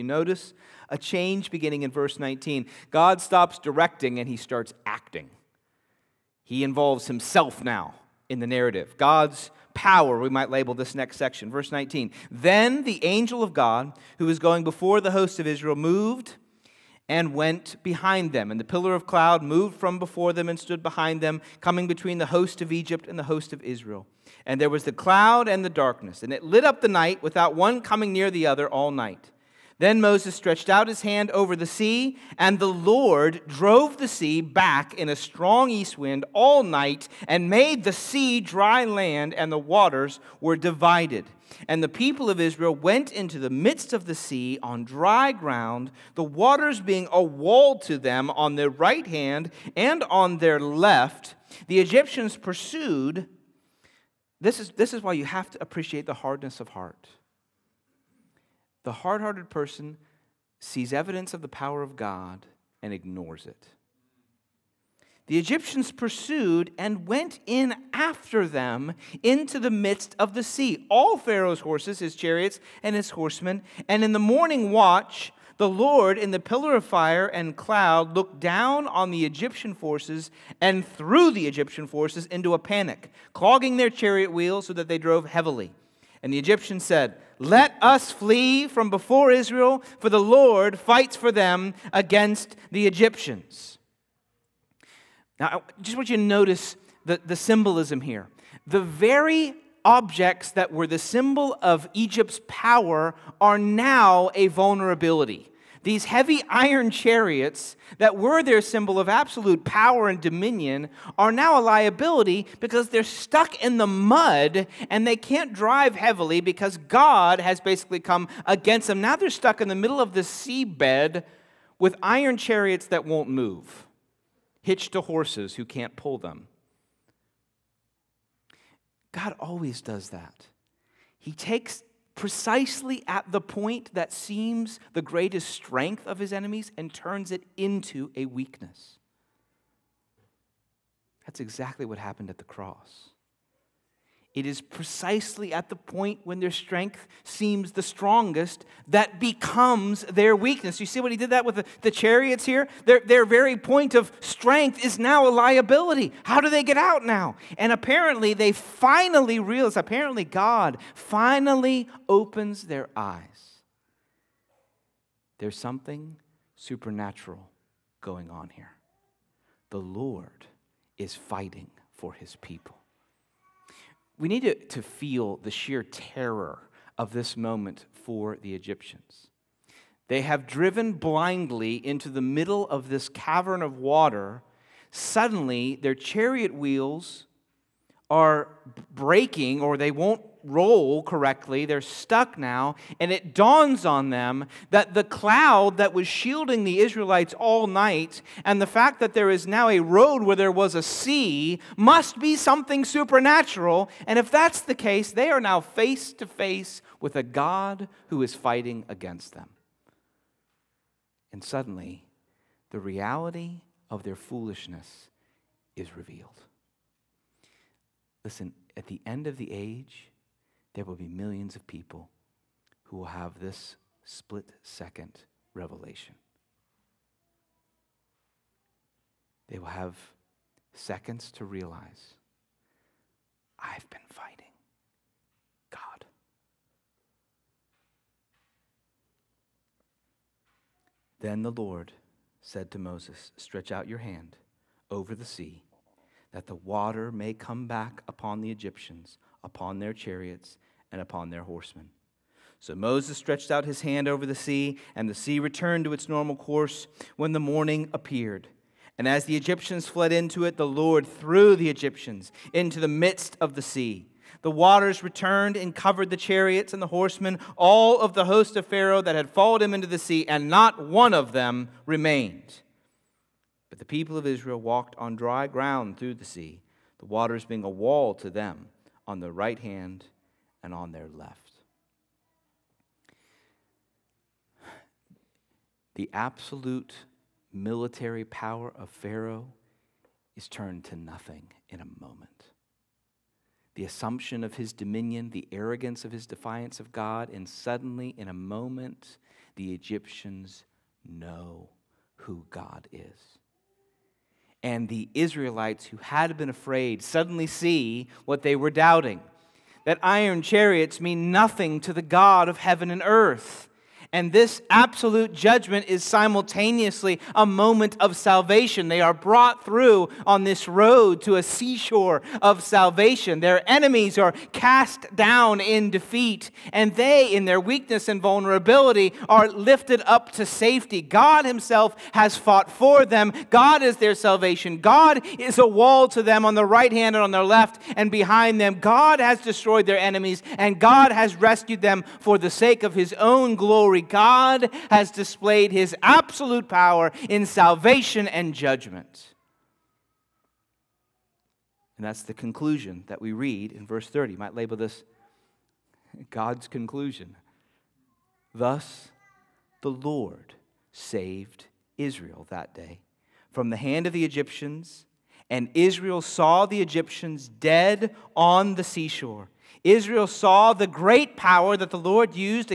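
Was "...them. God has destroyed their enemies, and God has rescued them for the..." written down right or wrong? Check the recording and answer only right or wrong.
right.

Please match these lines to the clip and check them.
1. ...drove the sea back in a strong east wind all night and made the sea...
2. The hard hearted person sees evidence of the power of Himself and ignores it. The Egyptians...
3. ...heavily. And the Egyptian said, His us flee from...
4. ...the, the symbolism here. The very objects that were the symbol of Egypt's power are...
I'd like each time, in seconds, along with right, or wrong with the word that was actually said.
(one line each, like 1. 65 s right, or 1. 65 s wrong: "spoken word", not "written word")
1. 33 s right
2. 58 s wrong: "God", not "Himself"
3. 85 s wrong: "Let", not "His"
4. 97 s right.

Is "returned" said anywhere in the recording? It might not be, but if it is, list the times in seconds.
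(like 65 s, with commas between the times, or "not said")
255 s, 265 s.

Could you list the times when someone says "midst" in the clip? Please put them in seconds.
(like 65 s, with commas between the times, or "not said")
43 s, 69 s, 262 s.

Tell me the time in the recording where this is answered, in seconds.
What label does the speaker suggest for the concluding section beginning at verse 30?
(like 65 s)
356 s.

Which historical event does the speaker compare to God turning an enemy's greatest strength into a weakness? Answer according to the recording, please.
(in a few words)
the cross.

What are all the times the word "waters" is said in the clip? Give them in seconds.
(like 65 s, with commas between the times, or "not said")
39 s, 46 s, 183 s, 246 s, 264 s, 277 s.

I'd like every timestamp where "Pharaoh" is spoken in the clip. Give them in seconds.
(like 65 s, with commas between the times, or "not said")
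71 s, 268 s, 288 s.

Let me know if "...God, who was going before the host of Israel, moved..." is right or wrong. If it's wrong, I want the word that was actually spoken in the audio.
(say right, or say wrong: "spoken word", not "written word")
right.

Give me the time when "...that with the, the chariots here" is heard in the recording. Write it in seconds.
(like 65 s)
151 s.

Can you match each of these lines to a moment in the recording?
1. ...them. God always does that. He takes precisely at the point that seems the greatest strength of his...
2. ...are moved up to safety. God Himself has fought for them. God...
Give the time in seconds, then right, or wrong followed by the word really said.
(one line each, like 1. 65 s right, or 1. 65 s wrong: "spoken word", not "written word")
1. 126 s right
2. 329 s wrong: "lifted", not "moved".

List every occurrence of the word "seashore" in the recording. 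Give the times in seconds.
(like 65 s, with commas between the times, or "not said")
321 s, 368 s.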